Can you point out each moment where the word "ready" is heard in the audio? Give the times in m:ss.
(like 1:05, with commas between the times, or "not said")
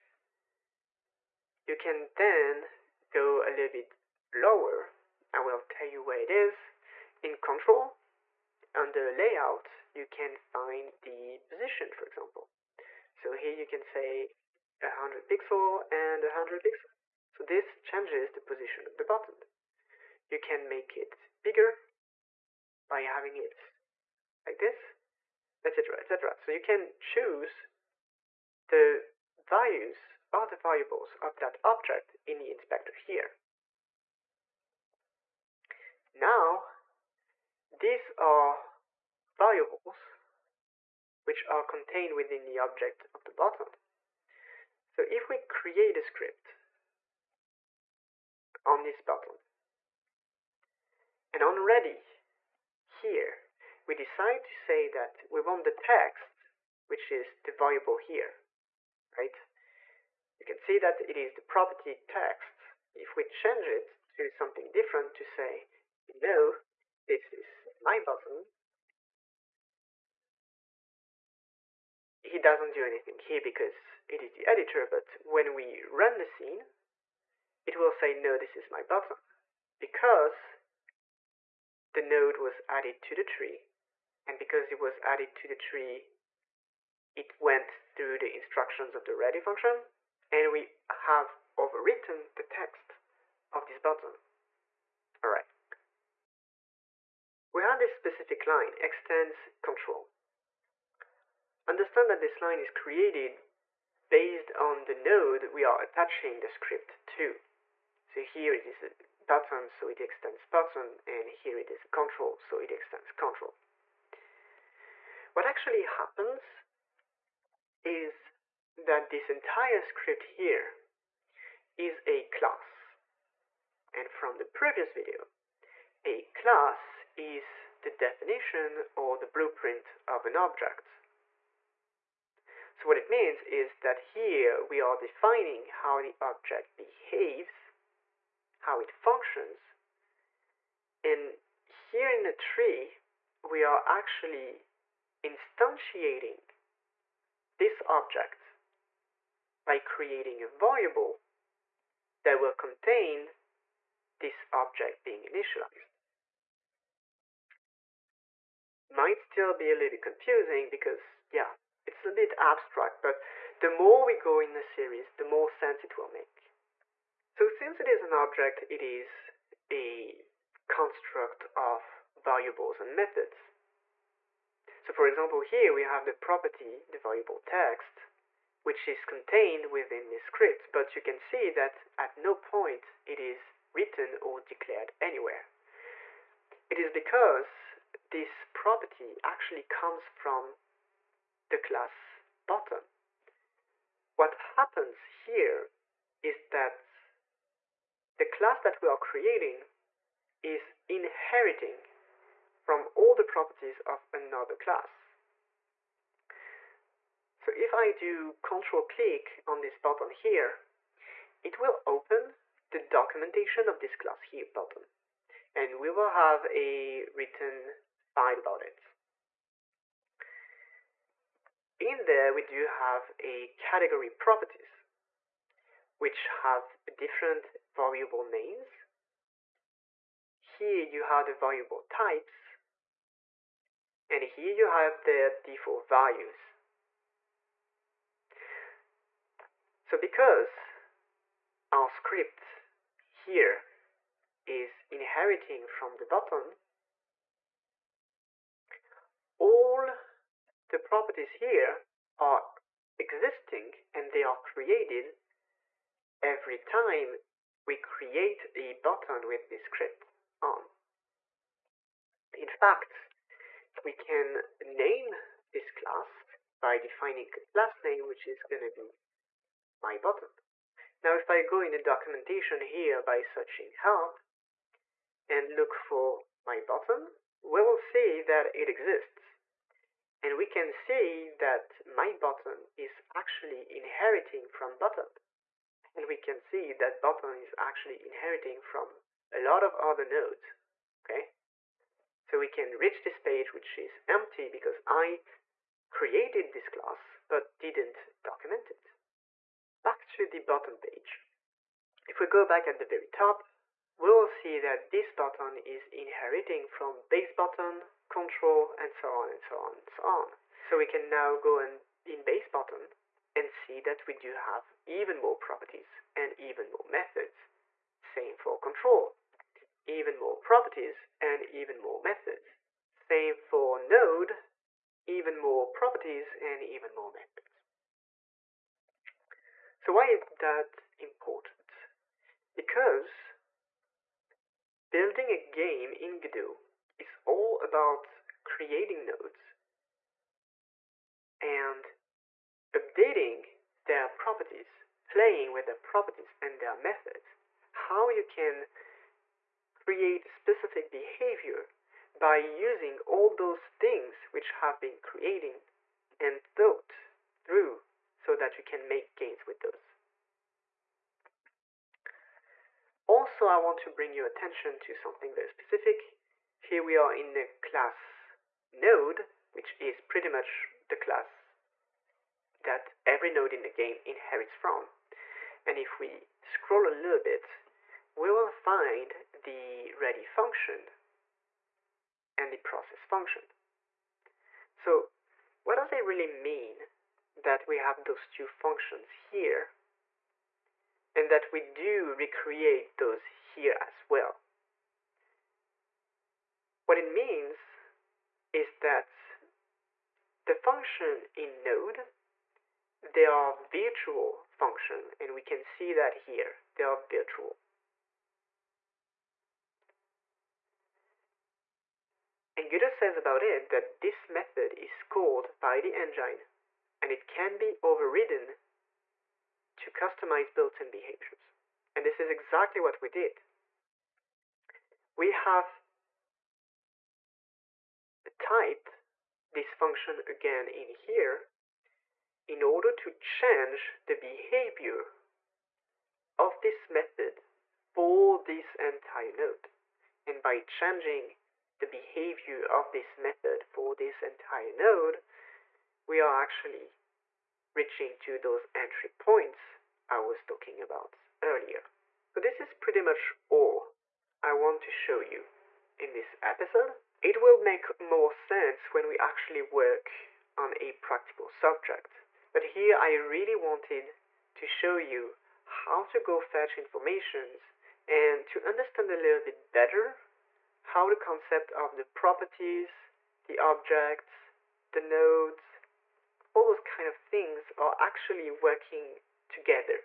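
0:51, 1:29, 6:19.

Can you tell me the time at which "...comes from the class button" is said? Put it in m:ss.
3:09.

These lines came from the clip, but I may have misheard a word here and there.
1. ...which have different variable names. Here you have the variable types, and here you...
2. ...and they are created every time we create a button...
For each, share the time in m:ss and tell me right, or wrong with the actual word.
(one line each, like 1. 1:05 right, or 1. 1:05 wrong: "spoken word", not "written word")
1. 3:45 right
2. 4:13 right.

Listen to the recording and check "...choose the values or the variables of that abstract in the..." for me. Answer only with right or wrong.
wrong.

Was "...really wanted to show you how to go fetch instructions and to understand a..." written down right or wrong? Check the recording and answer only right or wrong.
wrong.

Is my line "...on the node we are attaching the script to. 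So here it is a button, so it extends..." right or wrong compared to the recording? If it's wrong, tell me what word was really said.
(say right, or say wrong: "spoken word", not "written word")
right.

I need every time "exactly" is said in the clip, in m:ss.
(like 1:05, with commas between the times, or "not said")
7:02.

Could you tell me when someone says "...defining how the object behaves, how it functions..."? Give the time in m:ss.
2:14.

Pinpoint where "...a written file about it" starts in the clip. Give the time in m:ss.
3:36.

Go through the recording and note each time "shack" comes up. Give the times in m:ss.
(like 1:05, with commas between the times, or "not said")
not said.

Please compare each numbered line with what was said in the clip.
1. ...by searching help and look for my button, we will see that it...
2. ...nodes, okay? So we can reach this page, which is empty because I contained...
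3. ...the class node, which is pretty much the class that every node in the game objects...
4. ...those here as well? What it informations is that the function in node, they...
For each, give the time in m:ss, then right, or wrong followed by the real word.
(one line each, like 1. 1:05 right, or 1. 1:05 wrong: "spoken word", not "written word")
1. 4:33 right
2. 4:50 wrong: "created", not "contained"
3. 6:07 wrong: "inherits", not "objects"
4. 6:32 wrong: "means", not "informations".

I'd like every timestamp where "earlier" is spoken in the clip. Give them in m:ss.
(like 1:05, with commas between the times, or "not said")
7:31.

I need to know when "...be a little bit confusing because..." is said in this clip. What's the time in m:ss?
2:39.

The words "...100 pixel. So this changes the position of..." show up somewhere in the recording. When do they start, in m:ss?
0:16.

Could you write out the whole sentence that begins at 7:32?
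So this is pretty much all I want to show you in this episode.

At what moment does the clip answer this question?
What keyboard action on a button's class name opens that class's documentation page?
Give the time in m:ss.
3:28.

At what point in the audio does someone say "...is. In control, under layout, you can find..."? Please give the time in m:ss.
0:06.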